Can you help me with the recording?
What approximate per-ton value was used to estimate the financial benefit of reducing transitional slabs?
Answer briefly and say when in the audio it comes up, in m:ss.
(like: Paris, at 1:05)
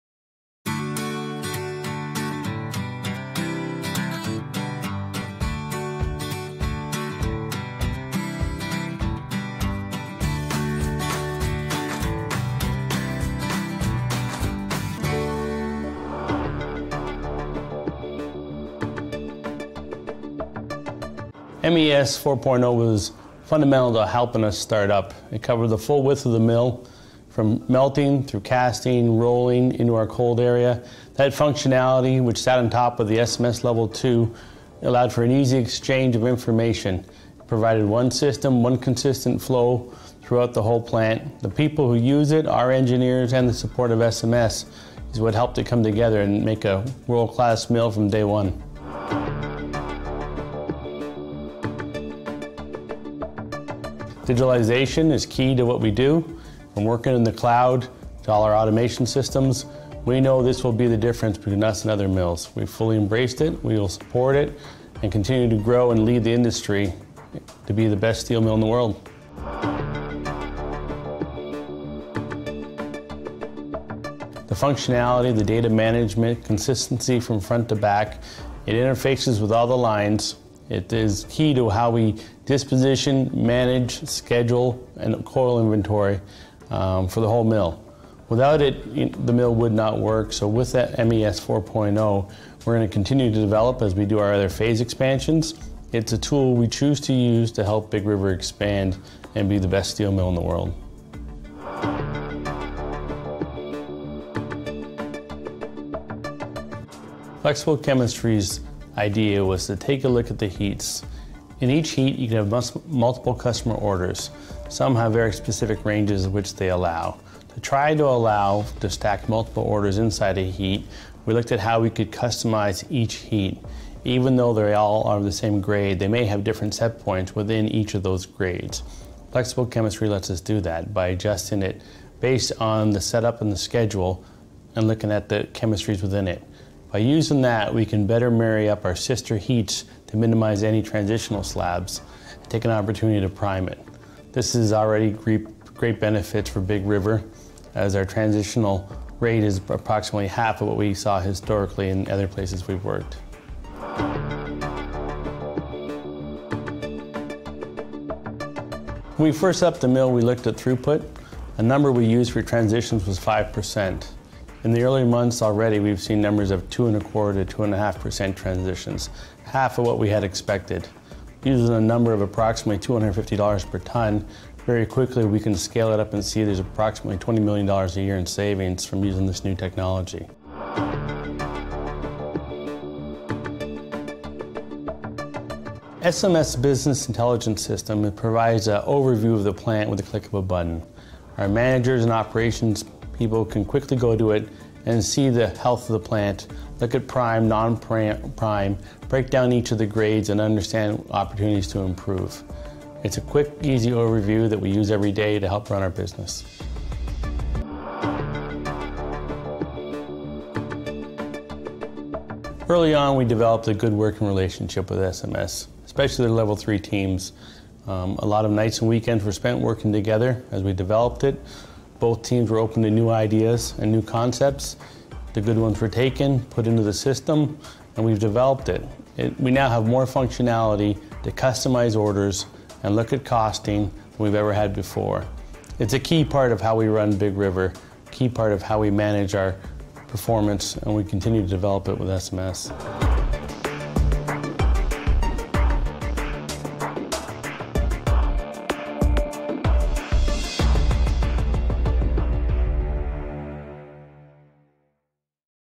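$250, at 2:52.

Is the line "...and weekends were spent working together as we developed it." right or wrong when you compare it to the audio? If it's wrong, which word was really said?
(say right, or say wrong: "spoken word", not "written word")
right.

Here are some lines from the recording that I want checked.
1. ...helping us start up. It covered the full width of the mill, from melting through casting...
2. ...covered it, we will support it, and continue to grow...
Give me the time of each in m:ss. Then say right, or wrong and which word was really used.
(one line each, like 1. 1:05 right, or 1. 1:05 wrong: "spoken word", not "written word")
1. 0:24 right
2. 1:02 wrong: "embraced", not "covered".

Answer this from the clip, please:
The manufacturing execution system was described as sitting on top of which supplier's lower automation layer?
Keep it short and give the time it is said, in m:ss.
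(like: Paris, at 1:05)
SMS Level 2, at 0:33.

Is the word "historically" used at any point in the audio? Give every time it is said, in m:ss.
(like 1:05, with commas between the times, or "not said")
2:31.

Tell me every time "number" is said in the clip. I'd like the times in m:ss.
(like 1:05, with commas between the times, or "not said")
2:41, 2:46, 2:51.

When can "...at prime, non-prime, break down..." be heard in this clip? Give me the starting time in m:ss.
3:16.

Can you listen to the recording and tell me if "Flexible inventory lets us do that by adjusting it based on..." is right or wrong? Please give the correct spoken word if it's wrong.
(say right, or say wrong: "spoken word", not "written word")
wrong: "chemistry", not "inventory".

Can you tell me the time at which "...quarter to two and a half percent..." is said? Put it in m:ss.
2:47.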